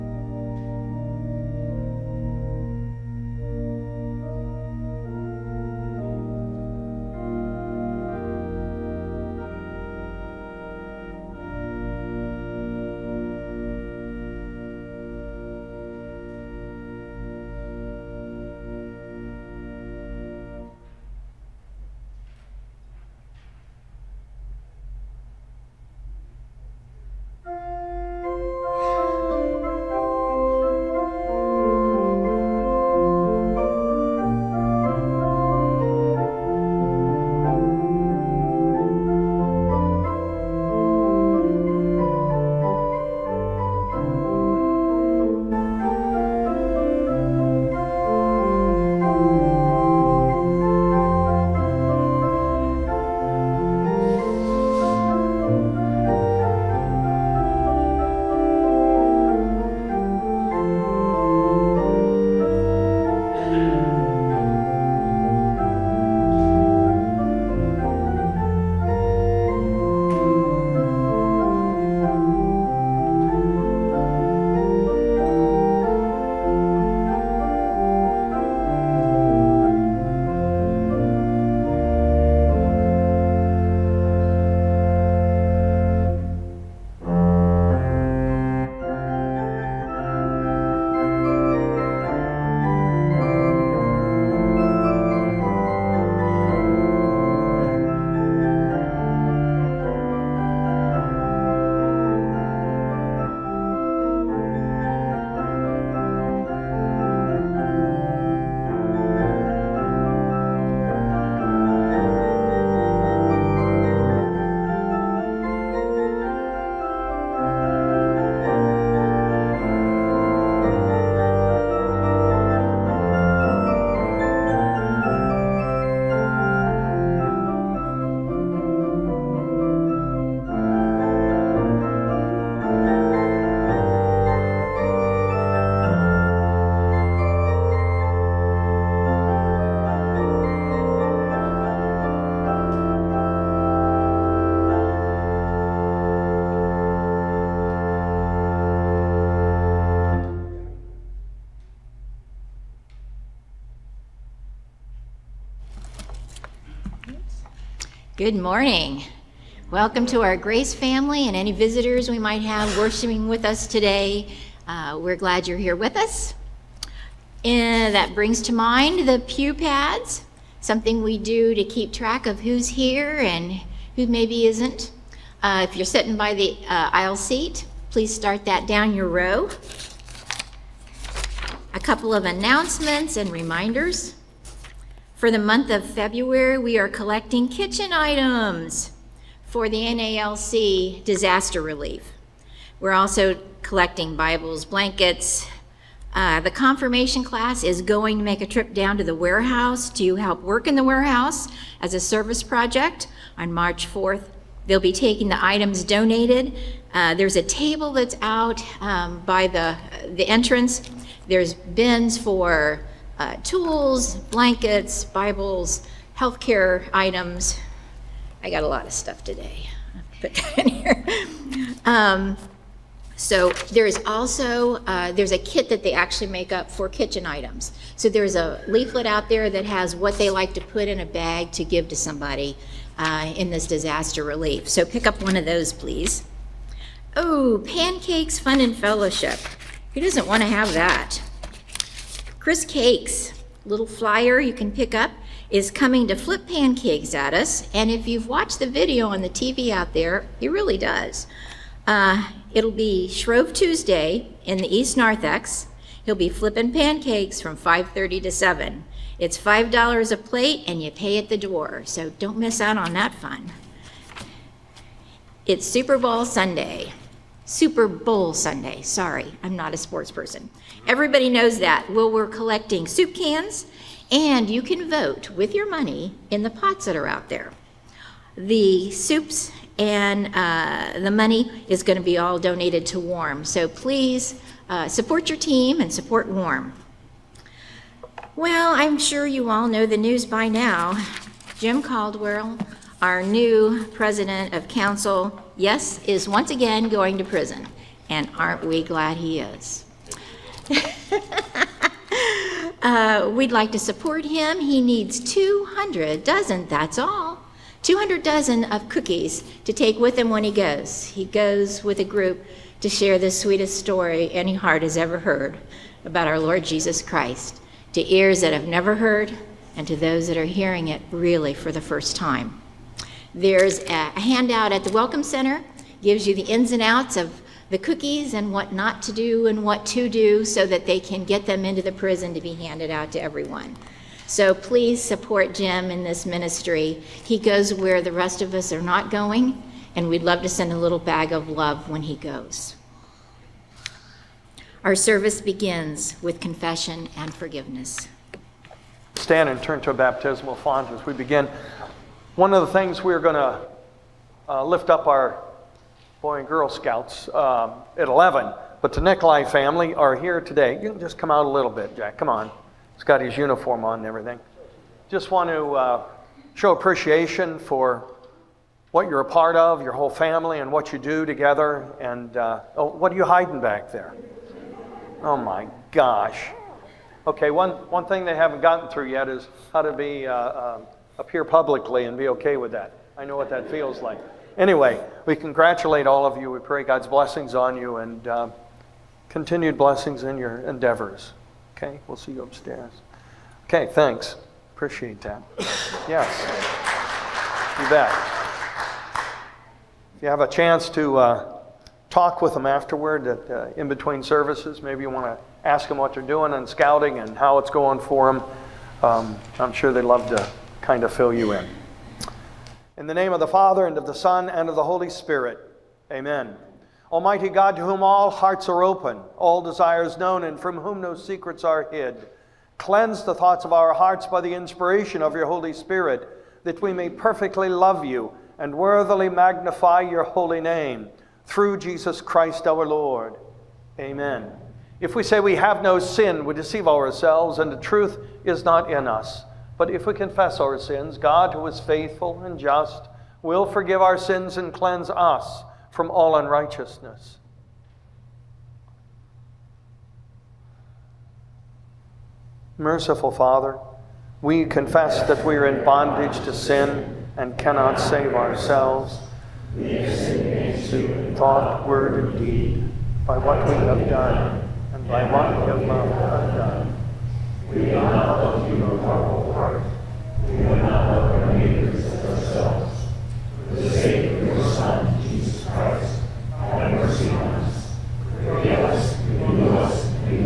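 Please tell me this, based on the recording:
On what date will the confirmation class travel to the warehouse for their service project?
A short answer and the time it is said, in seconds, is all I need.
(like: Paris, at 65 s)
March 4, at 203 s.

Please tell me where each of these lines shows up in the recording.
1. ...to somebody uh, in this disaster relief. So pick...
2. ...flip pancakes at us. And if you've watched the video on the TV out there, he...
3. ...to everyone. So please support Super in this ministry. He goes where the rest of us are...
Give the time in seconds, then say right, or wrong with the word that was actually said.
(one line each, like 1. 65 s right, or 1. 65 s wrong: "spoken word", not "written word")
1. 231 s right
2. 246 s right
3. 333 s wrong: "Jim", not "Super".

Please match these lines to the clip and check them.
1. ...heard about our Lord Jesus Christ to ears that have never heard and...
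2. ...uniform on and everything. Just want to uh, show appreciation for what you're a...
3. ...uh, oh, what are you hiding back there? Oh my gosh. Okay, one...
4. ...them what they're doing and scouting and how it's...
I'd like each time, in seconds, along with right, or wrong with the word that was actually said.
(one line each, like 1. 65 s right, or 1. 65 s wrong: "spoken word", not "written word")
1. 315 s right
2. 363 s right
3. 372 s right
4. 405 s right.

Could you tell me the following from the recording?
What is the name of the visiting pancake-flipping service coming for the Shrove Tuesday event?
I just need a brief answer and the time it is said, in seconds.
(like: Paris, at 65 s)
Chris Cakes, at 242 s.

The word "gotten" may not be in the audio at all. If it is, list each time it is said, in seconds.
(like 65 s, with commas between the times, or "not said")
378 s.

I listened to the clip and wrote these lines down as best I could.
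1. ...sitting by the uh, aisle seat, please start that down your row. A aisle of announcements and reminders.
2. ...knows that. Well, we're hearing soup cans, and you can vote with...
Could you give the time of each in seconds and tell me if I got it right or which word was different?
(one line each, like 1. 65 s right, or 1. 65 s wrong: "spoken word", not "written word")
1. 175 s wrong: "couple", not "aisle"
2. 271 s wrong: "collecting", not "hearing".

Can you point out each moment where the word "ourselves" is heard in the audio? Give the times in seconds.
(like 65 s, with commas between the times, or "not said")
436 s, 458 s.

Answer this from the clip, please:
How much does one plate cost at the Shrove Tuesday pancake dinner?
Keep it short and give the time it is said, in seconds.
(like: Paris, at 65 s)
$5, at 259 s.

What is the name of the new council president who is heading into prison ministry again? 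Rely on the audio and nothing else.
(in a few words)
Jim Caldwell.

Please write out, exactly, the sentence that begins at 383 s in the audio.
I know what that feels like.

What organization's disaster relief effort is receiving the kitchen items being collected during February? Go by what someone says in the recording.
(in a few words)
NALC.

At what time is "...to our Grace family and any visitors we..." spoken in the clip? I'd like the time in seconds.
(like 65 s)
160 s.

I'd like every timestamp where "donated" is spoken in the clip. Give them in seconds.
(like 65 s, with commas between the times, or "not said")
205 s, 282 s.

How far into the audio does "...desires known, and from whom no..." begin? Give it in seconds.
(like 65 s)
419 s.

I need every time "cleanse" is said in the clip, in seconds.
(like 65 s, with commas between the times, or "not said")
422 s, 444 s.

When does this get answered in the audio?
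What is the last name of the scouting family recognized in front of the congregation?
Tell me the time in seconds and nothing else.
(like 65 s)
359 s.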